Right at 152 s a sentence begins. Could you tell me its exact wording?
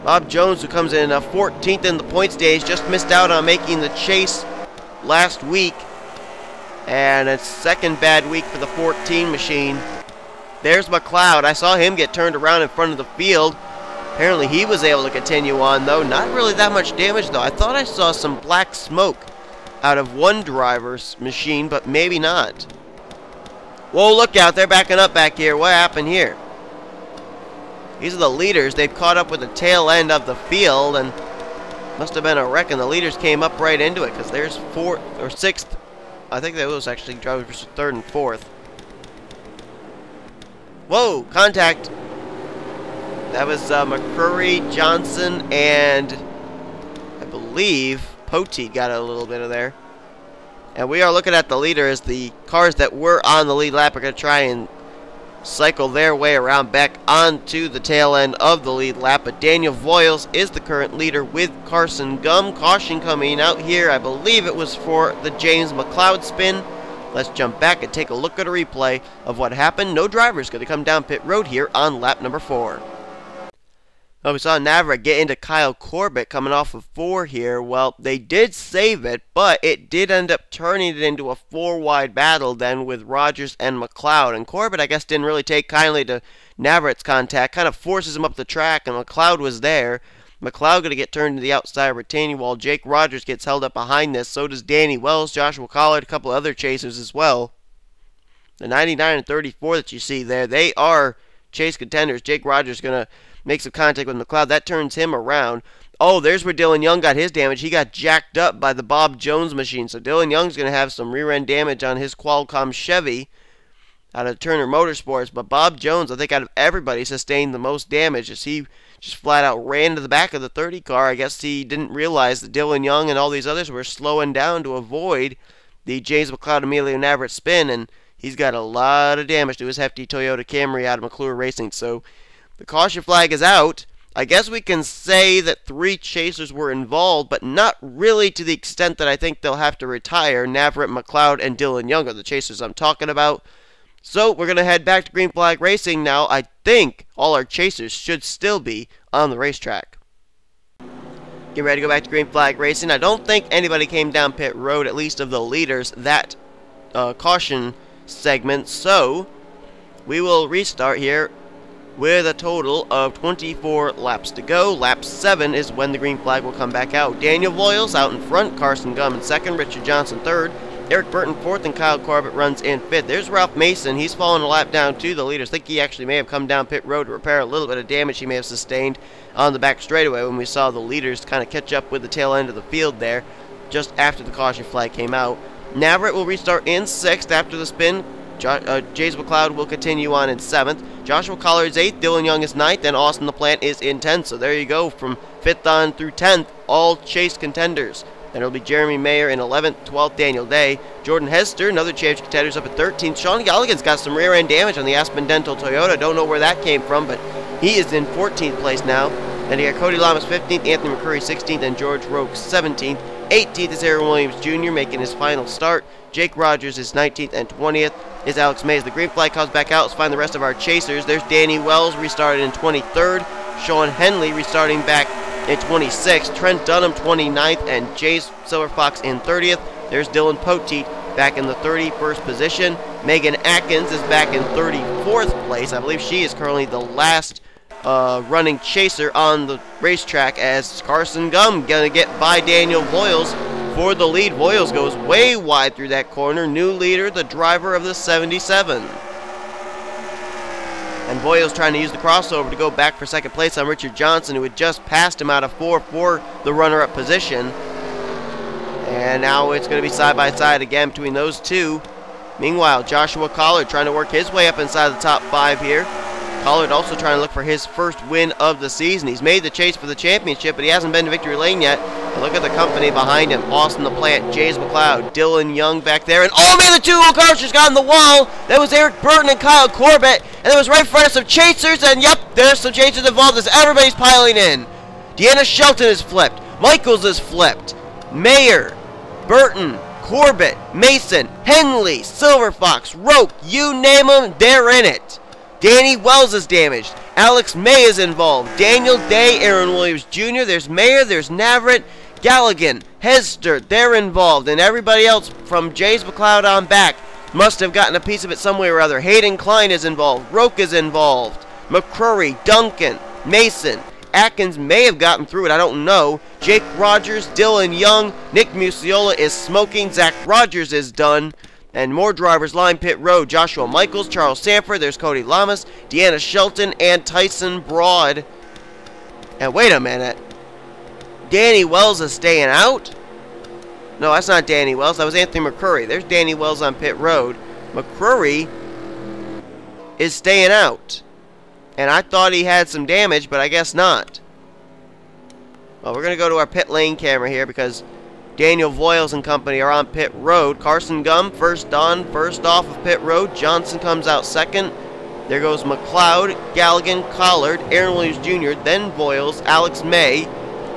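I don't think anybody came down pit road, at least of the leaders, that uh, caution segment.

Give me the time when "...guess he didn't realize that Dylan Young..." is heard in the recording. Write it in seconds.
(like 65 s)
121 s.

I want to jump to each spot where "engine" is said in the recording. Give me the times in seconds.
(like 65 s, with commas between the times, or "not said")
not said.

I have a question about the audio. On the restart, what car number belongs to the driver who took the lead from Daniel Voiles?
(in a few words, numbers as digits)
77.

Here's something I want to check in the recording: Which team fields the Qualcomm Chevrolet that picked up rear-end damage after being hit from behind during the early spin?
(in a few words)
Turner Motorsports.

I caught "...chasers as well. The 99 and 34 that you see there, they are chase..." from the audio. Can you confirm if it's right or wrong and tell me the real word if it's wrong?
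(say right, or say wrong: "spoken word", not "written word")
right.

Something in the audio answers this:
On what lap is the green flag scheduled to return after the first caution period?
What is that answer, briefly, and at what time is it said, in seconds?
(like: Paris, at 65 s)
7, at 164 s.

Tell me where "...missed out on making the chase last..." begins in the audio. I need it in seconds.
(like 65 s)
2 s.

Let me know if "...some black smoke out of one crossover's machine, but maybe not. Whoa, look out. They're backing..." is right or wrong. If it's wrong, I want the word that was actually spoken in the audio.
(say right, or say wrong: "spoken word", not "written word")
wrong: "driver", not "crossover".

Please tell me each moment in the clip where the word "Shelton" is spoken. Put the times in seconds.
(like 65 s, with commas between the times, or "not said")
285 s, 326 s.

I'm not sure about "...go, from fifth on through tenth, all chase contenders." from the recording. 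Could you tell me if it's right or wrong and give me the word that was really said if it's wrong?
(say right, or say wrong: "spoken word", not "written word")
right.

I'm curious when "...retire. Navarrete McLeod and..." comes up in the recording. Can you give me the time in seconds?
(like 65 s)
139 s.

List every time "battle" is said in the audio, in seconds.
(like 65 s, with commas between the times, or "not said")
82 s.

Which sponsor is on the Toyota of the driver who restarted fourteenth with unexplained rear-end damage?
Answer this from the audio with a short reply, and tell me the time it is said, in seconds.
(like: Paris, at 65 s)
Aspen Dental, at 204 s.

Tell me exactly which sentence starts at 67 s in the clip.
Let's jump back and take a look at a replay of what happened.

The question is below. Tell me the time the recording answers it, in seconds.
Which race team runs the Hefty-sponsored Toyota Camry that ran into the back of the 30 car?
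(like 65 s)
131 s.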